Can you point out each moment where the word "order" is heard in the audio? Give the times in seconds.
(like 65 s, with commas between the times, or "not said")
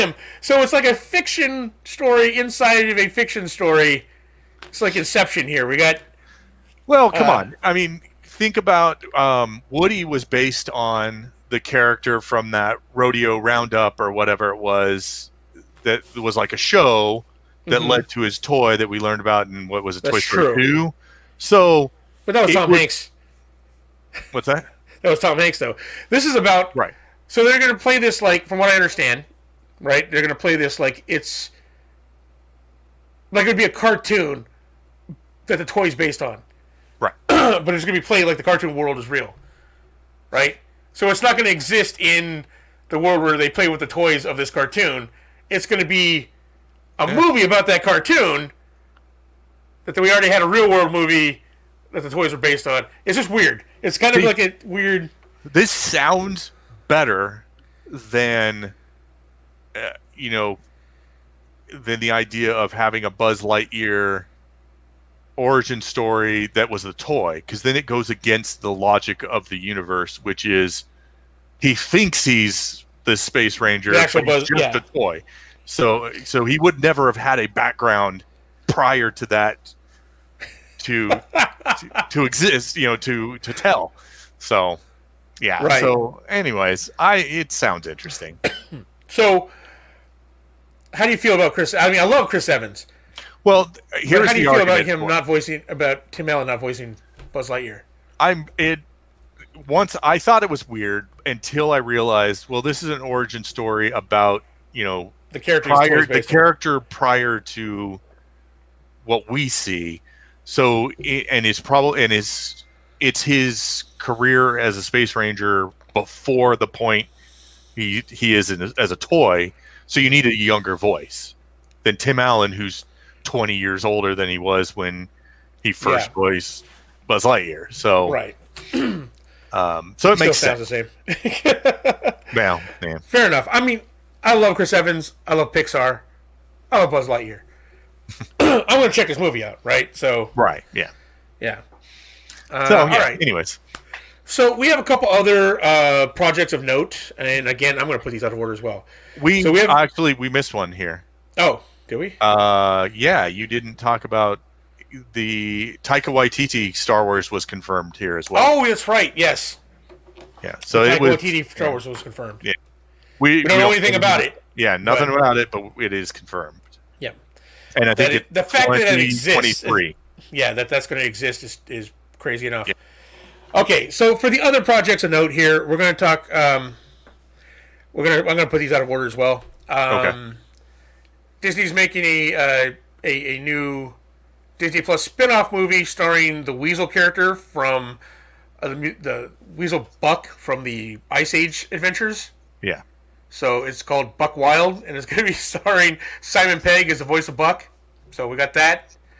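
148 s, 178 s.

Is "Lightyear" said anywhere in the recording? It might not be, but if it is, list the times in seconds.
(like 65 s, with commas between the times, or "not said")
63 s, 97 s, 127 s, 137 s.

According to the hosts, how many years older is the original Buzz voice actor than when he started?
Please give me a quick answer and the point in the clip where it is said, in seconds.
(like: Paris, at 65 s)
20, at 123 s.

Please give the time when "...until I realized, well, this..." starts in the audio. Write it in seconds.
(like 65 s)
101 s.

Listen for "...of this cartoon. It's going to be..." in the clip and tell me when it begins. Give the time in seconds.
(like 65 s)
44 s.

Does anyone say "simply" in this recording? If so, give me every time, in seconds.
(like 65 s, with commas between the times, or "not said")
not said.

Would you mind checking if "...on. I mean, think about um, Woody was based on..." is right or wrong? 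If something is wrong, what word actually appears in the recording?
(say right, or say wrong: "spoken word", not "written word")
right.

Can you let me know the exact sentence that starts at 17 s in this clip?
led to his toy that we learned about in what was it, That's Toy Story Two.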